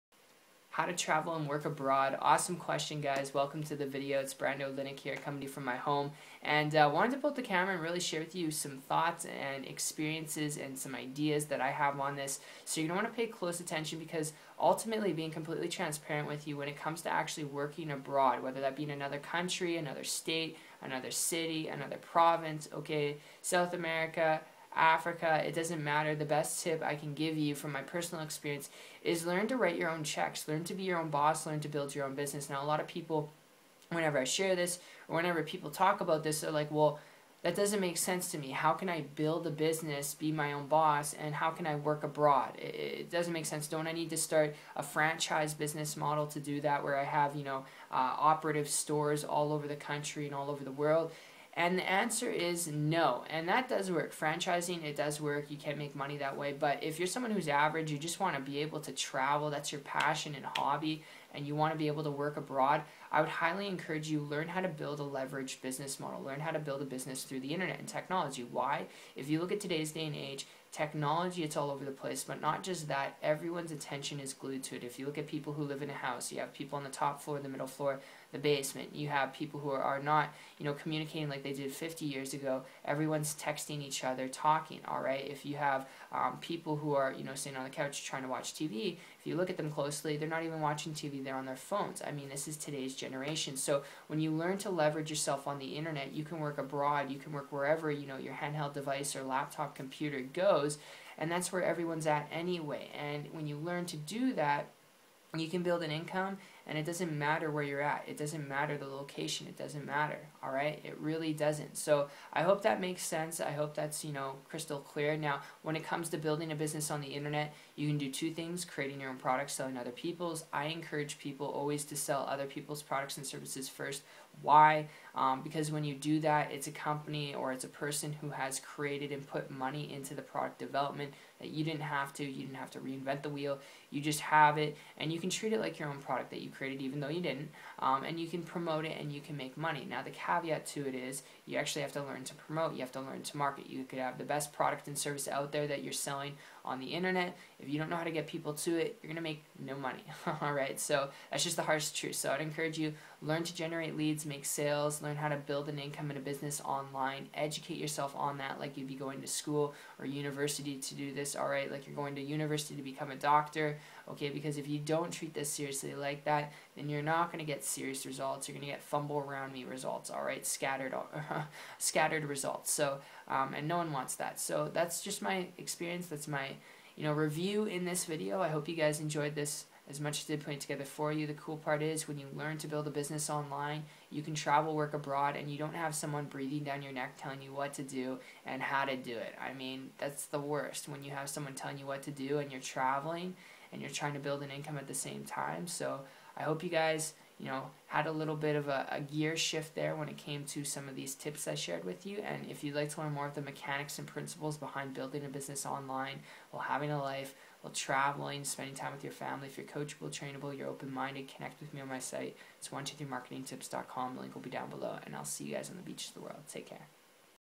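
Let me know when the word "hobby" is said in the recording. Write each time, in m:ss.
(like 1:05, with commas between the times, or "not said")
1:00.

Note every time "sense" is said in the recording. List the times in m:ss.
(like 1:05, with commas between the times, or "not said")
0:37, 0:43, 1:53.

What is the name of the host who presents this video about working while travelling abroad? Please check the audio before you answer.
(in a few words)
Brando Linick.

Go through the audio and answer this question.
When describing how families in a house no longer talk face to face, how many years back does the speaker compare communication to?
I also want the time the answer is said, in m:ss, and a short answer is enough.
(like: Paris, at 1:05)
50, at 1:21.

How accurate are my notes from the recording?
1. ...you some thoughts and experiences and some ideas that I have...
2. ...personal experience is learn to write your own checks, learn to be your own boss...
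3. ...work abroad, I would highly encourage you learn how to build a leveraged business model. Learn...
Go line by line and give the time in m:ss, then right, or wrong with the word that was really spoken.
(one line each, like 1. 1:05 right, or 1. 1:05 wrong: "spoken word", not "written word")
1. 0:08 right
2. 0:27 right
3. 1:02 right.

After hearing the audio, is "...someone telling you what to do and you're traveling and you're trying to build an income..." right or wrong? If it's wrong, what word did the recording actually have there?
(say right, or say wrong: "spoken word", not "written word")
right.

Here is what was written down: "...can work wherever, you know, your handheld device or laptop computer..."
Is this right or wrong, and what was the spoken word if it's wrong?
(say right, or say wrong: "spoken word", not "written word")
right.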